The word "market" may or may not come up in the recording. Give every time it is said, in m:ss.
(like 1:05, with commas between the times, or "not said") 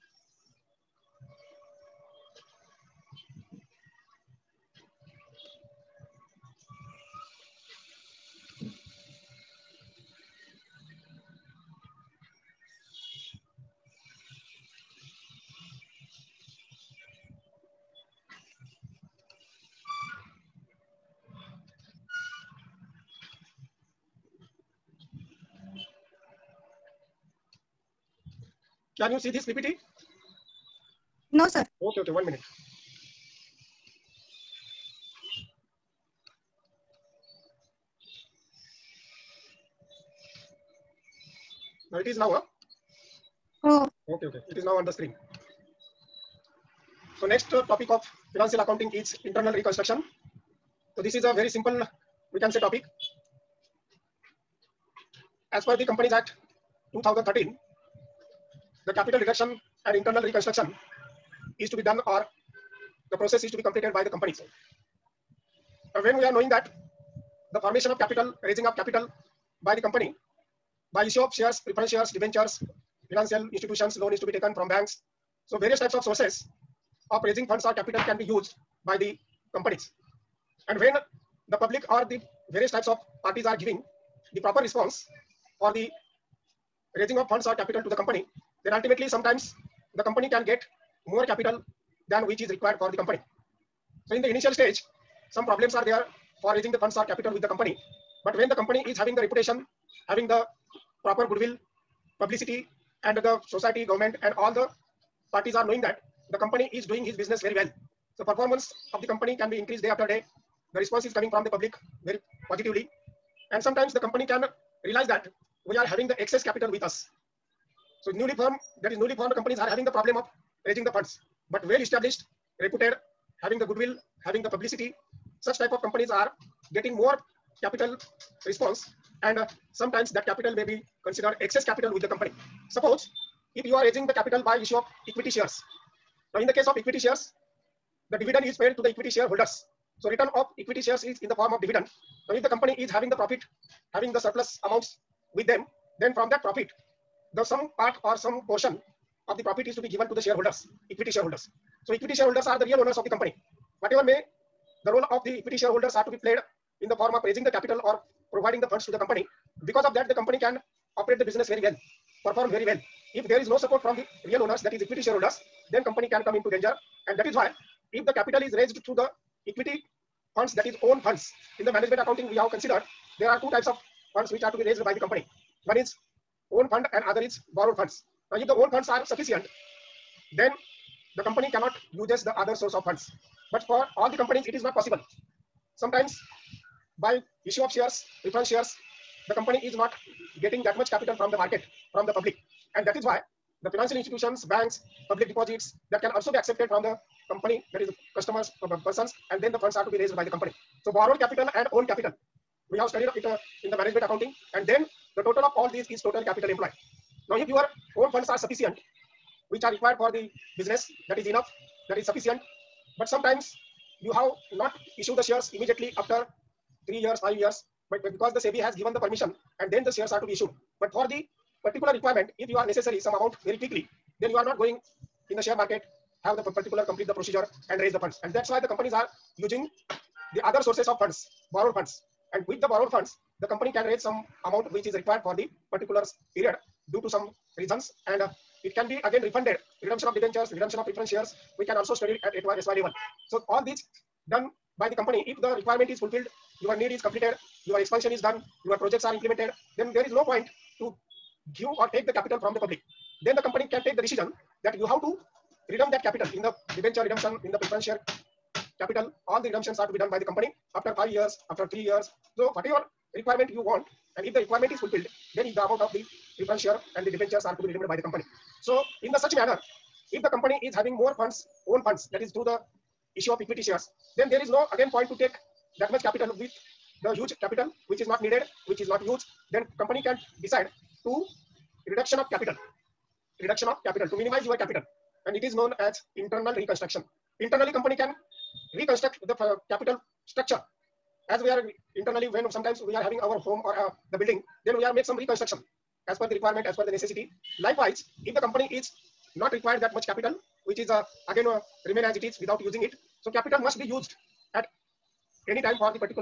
3:11, 3:45.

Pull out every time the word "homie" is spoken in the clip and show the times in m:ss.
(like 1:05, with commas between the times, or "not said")
not said.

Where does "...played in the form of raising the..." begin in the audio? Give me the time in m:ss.
2:36.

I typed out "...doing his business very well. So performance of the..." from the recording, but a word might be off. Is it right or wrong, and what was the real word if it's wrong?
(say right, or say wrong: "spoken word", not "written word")
right.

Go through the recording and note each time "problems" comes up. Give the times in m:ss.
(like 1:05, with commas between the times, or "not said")
1:35, 1:59.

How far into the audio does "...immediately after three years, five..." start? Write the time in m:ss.
3:35.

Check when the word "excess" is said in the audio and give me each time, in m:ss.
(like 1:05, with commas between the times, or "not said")
1:56, 2:11.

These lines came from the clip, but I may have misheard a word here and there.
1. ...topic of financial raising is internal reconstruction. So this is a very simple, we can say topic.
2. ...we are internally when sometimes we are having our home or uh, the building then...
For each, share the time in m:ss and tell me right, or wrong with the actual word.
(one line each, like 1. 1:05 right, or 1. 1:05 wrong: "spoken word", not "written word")
1. 0:47 wrong: "accounting", not "raising"
2. 4:51 right.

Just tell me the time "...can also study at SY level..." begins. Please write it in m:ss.
4:01.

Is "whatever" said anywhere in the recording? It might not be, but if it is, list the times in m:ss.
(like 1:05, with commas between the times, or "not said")
2:33, 4:22.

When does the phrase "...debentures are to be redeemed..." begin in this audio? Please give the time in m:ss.
4:27.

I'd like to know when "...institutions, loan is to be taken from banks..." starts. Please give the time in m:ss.
1:13.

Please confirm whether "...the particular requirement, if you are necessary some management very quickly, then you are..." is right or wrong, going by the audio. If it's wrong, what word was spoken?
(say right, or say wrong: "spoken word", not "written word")
wrong: "amount", not "management".